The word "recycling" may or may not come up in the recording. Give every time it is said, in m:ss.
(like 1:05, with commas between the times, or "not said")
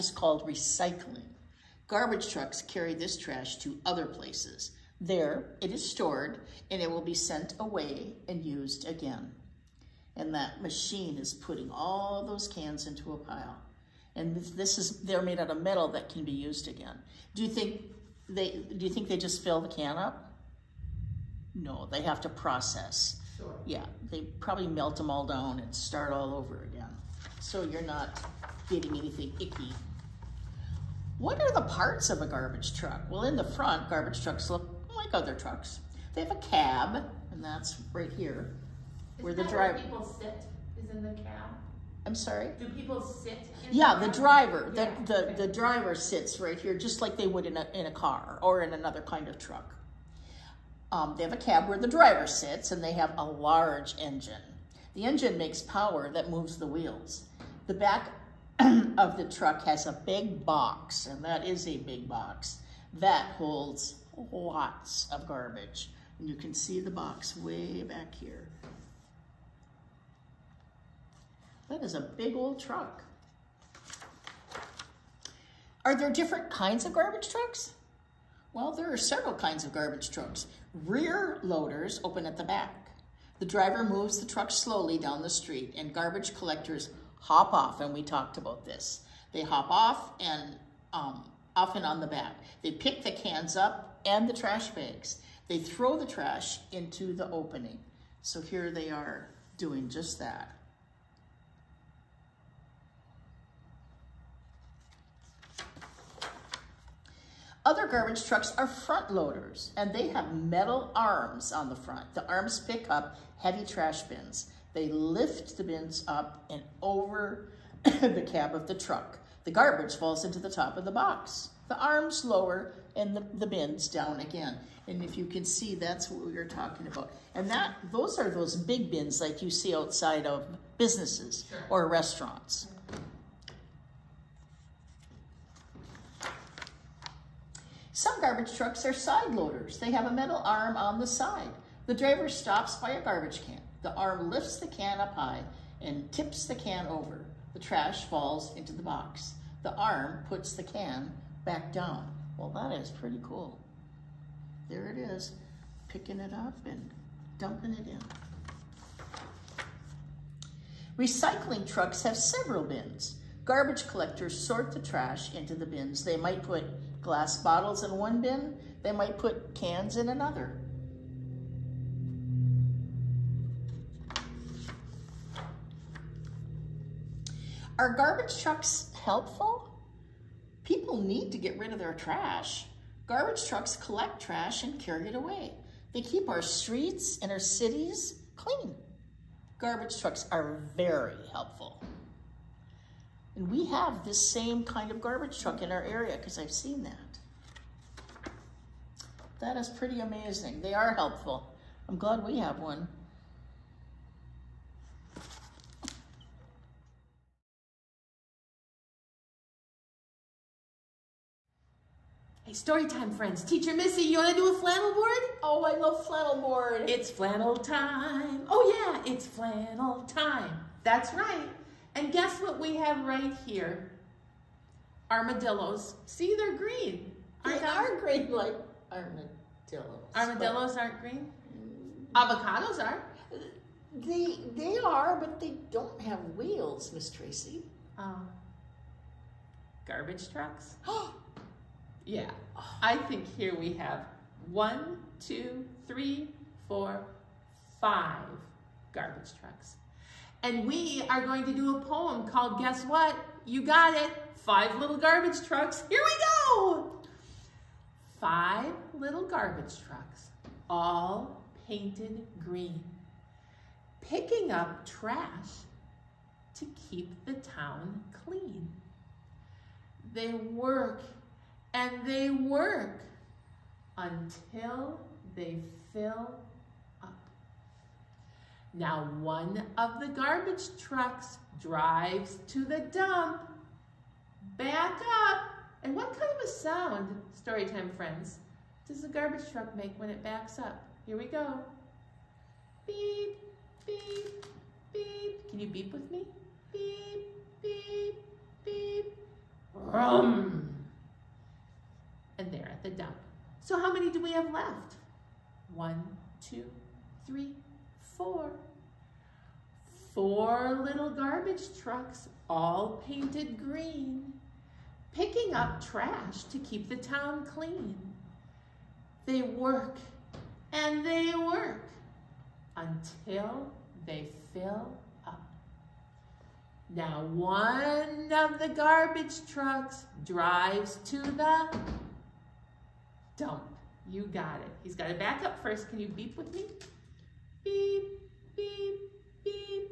0:00, 2:40.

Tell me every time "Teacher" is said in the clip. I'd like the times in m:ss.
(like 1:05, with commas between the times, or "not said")
3:33.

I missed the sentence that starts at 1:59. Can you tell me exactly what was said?
The garbage falls into the top of the box.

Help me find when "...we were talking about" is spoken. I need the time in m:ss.
2:06.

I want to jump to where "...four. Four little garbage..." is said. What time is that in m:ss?
5:08.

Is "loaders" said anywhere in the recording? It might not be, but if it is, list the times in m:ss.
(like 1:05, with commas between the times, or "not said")
1:21, 1:49, 2:19.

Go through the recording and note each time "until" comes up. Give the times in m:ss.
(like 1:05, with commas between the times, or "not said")
4:33, 5:22.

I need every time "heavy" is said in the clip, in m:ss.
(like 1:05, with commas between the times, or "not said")
1:53.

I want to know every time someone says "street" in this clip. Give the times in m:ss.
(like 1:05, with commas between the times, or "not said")
1:25, 3:06.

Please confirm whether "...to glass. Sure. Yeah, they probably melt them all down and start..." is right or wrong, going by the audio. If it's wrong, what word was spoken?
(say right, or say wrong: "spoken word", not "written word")
wrong: "process", not "glass".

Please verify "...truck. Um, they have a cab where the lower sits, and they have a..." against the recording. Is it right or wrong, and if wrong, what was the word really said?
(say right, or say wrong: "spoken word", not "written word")
wrong: "driver", not "lower".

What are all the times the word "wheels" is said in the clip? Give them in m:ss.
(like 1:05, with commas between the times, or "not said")
0:56, 3:56.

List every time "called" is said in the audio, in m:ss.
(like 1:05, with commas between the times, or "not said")
0:00, 4:12.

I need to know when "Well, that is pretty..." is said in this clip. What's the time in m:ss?
2:32.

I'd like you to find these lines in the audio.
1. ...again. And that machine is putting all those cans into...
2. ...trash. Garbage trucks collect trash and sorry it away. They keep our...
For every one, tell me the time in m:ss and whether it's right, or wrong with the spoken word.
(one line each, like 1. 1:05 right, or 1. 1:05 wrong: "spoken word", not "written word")
1. 0:08 right
2. 3:01 wrong: "carry", not "sorry".